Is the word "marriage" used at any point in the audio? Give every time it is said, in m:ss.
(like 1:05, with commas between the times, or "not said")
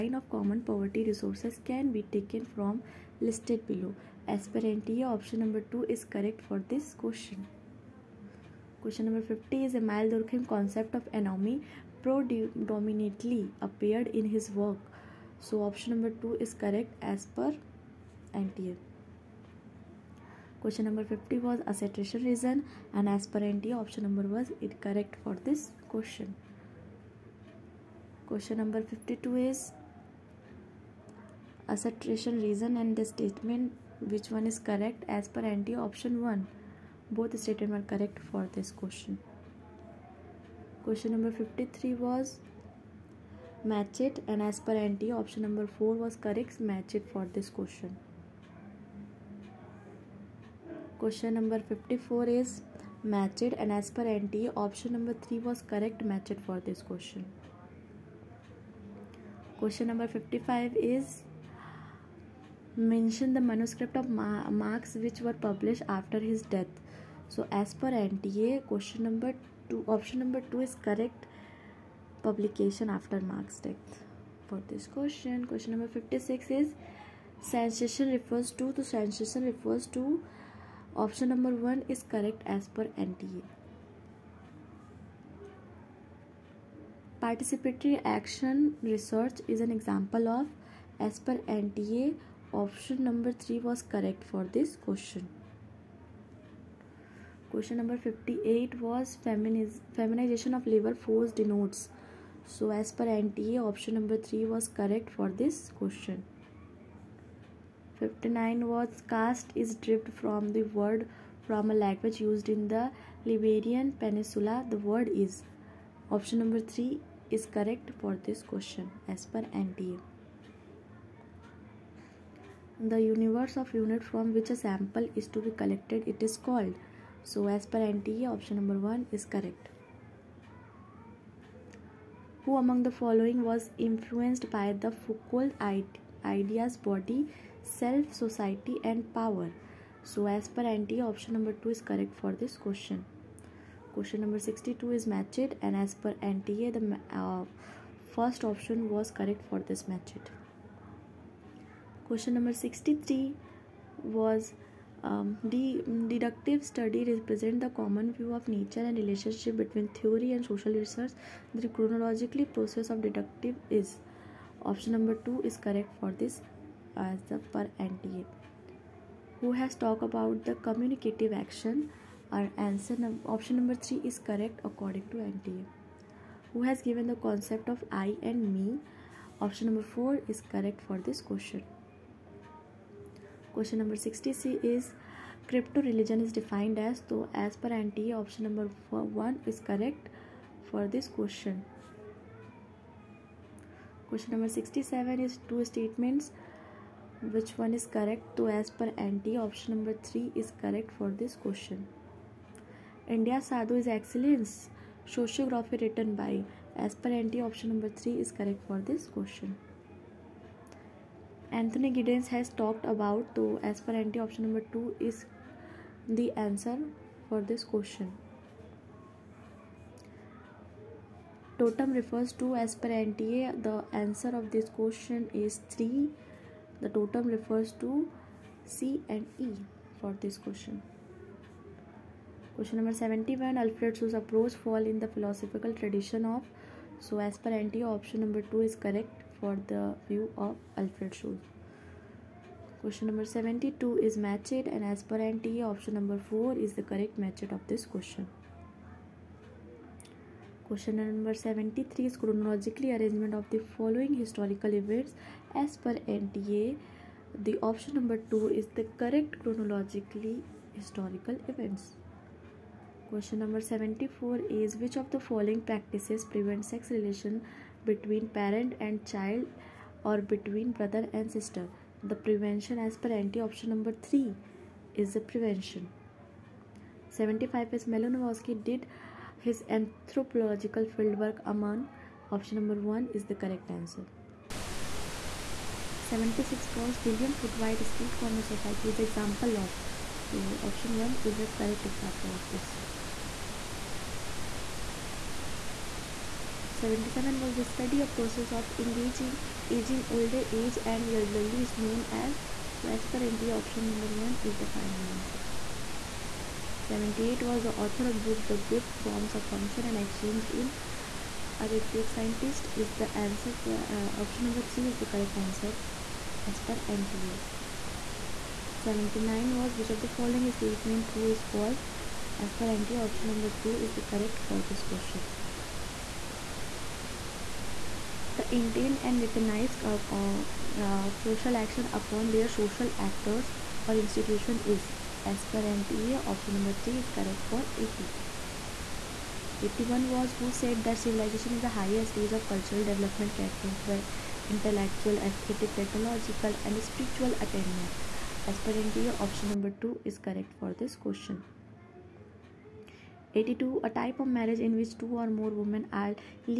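5:54.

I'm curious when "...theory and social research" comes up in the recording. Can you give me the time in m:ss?
2:39.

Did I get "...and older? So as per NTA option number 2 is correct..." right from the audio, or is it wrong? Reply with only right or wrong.
wrong.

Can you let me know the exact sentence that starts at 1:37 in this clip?
Question number 58 was feminiz feminization of labor force denotes.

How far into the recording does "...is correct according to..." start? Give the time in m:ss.
2:54.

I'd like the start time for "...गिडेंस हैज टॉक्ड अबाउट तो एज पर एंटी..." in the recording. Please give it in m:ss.
3:31.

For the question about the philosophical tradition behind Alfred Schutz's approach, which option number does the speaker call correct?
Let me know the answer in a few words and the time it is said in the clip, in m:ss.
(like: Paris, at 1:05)
2, at 3:57.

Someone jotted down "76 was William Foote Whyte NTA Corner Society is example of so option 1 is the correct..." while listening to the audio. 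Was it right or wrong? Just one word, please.
wrong.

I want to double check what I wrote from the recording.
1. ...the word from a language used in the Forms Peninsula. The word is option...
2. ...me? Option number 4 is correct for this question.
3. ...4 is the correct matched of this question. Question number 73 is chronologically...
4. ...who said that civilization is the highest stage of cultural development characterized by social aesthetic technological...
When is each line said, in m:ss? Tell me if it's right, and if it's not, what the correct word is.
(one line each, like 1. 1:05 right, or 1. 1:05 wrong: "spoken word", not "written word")
1. 1:50 wrong: "Iberian", not "Forms"
2. 2:58 right
3. 4:06 right
4. 5:40 wrong: "intellectual", not "social".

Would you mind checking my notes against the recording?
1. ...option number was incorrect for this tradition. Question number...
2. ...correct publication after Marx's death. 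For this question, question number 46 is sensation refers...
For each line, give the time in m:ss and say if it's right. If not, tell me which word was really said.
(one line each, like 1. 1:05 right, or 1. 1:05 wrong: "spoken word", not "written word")
1. 0:23 wrong: "question", not "tradition"
2. 1:10 wrong: "56", not "46".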